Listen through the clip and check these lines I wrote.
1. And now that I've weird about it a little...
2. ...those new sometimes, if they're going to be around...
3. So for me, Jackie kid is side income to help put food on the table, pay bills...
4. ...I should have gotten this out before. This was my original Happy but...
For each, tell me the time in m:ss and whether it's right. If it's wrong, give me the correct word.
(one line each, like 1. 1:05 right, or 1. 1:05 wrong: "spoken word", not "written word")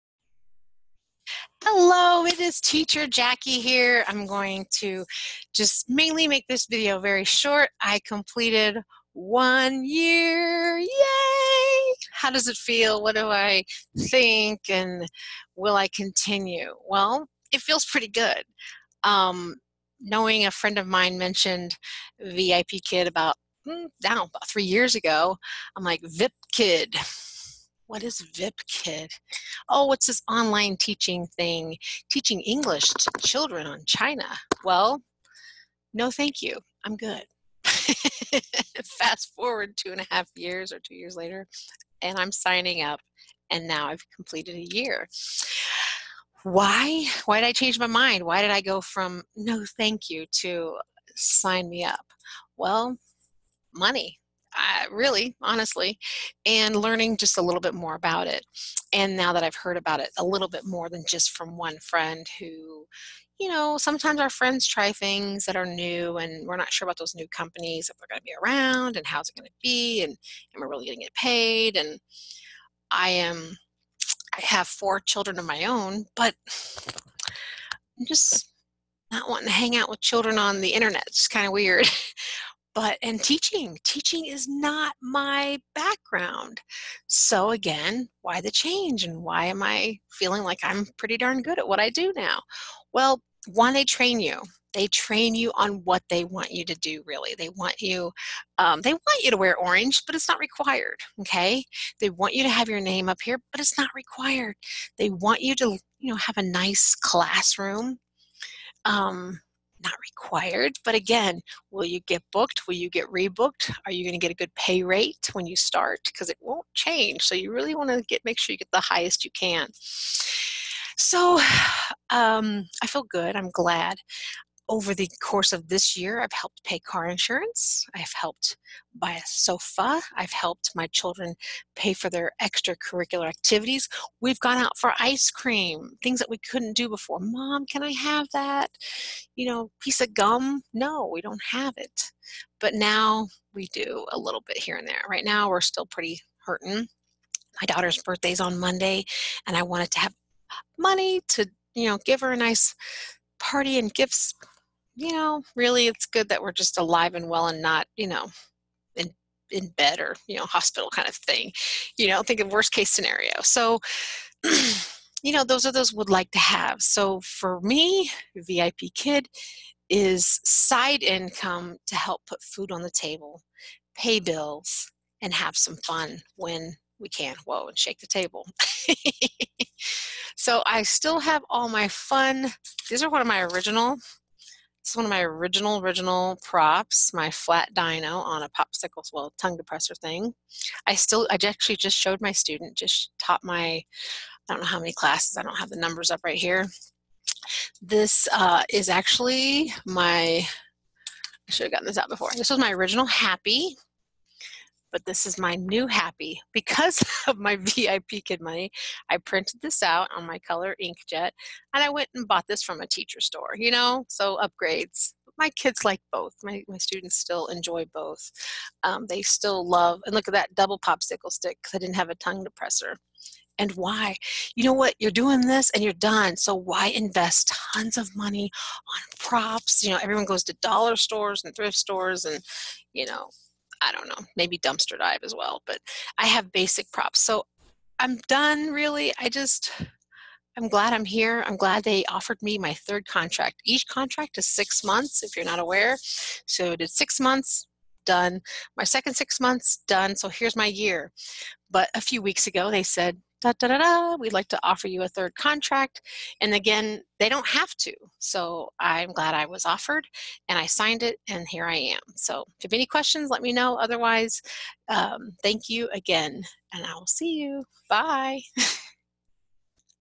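1. 0:58 wrong: "heard", not "weird"
2. 1:06 wrong: "companies", not "sometimes"
3. 2:46 wrong: "VIP", not "Jackie"
4. 3:20 right.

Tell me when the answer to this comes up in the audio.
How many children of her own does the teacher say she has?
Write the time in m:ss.
1:14.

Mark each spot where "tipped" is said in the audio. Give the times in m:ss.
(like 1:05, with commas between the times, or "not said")
not said.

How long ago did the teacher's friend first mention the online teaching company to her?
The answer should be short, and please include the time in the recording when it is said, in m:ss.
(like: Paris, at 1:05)
3 years, at 0:24.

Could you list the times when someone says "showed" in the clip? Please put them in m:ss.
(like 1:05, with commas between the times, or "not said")
3:11.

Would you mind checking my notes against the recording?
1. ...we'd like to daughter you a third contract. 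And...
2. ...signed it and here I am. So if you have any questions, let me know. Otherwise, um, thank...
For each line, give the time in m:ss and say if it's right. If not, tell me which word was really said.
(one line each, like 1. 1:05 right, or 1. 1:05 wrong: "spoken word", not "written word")
1. 4:14 wrong: "offer", not "daughter"
2. 4:20 right.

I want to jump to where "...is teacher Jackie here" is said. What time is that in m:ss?
0:02.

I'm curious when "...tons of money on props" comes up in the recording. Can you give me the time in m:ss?
3:47.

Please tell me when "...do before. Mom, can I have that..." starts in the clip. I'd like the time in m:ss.
2:16.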